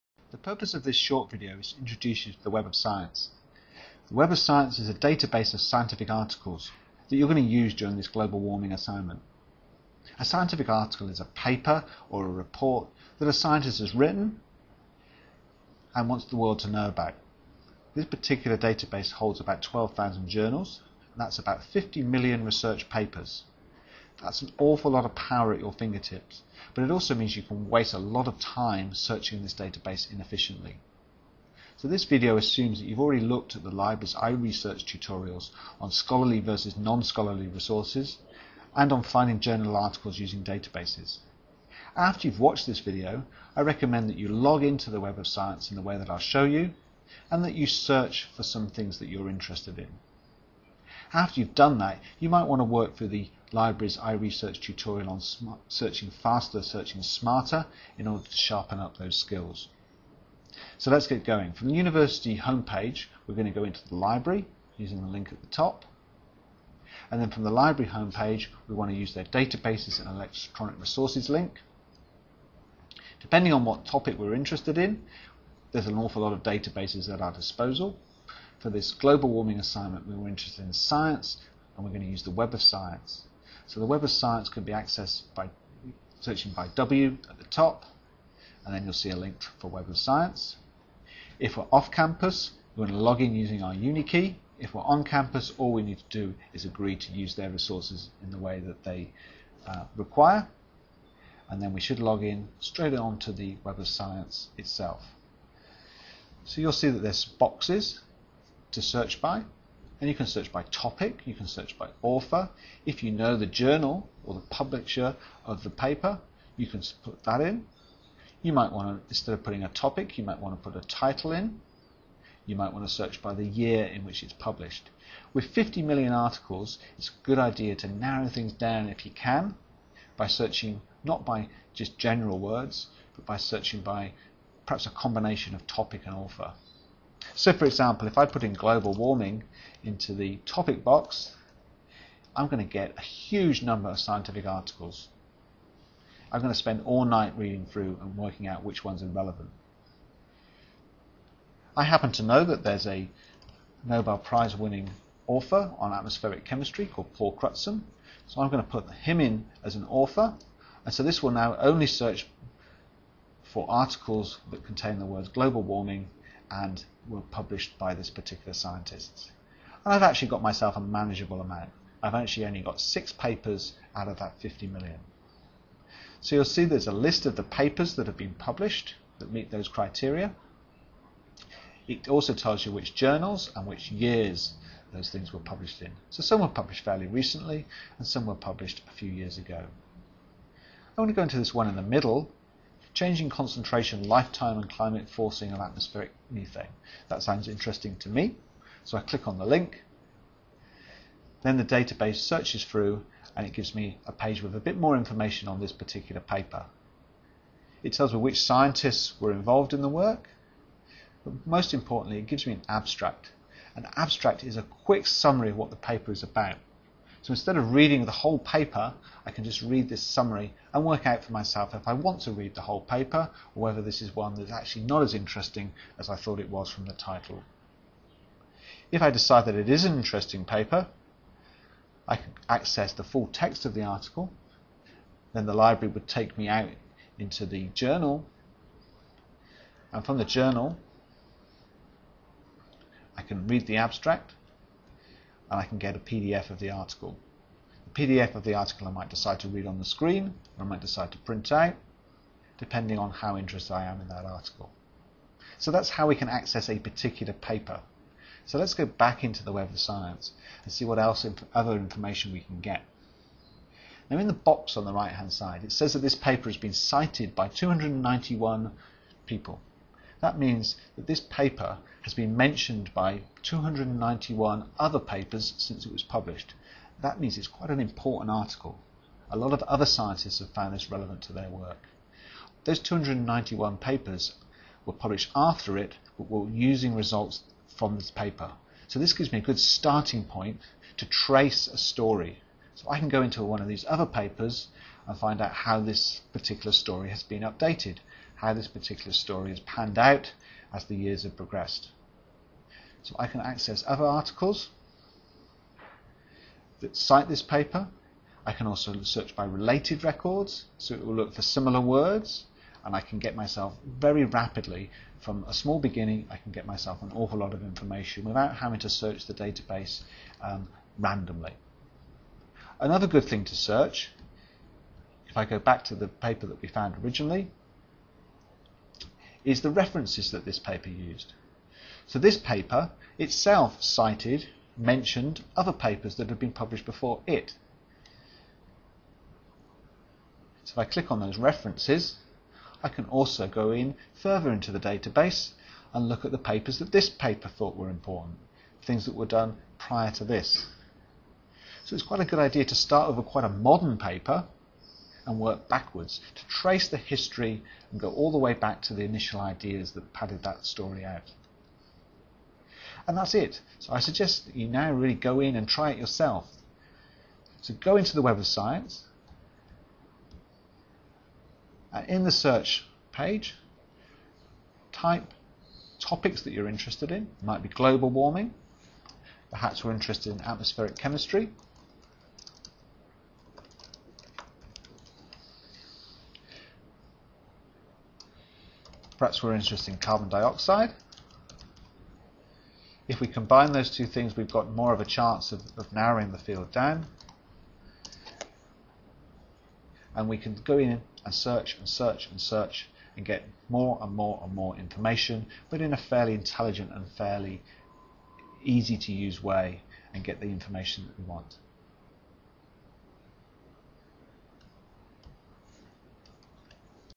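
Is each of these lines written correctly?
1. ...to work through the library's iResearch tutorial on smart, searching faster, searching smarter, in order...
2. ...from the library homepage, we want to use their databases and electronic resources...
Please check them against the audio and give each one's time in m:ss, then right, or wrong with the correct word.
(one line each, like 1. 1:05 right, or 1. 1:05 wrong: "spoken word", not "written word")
1. 0:52 right
2. 1:07 right.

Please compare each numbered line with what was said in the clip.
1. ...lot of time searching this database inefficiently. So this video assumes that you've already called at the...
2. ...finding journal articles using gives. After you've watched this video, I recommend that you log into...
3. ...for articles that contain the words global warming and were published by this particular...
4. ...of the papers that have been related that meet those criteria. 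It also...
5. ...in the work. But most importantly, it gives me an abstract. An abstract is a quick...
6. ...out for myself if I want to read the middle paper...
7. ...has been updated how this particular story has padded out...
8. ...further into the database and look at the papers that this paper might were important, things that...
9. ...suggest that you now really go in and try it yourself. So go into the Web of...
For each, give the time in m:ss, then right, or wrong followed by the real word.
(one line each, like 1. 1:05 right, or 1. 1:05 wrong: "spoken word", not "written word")
1. 0:27 wrong: "looked", not "called"
2. 0:39 wrong: "databases", not "gives"
3. 2:43 right
4. 2:57 wrong: "published", not "related"
5. 3:29 right
6. 3:41 wrong: "whole", not "middle"
7. 4:57 wrong: "panned", not "padded"
8. 5:44 wrong: "thought", not "might"
9. 6:03 right.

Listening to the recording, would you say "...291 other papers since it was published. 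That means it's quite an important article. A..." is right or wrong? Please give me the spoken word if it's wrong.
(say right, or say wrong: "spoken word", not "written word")
right.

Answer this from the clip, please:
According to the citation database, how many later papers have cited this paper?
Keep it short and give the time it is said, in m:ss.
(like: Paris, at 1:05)
291, at 4:27.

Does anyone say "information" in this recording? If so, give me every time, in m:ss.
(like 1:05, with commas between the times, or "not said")
3:24, 4:21, 5:17, 6:44, 6:50.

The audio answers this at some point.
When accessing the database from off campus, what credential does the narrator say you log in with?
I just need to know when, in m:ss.
1:33.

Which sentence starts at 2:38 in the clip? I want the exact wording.
So I'm going to put him in as an author.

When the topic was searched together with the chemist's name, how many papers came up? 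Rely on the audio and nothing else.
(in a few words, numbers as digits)
6.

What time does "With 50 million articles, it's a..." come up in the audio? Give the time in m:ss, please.
2:05.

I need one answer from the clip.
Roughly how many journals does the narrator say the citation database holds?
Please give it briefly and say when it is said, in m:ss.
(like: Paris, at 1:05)
12,000, at 0:19.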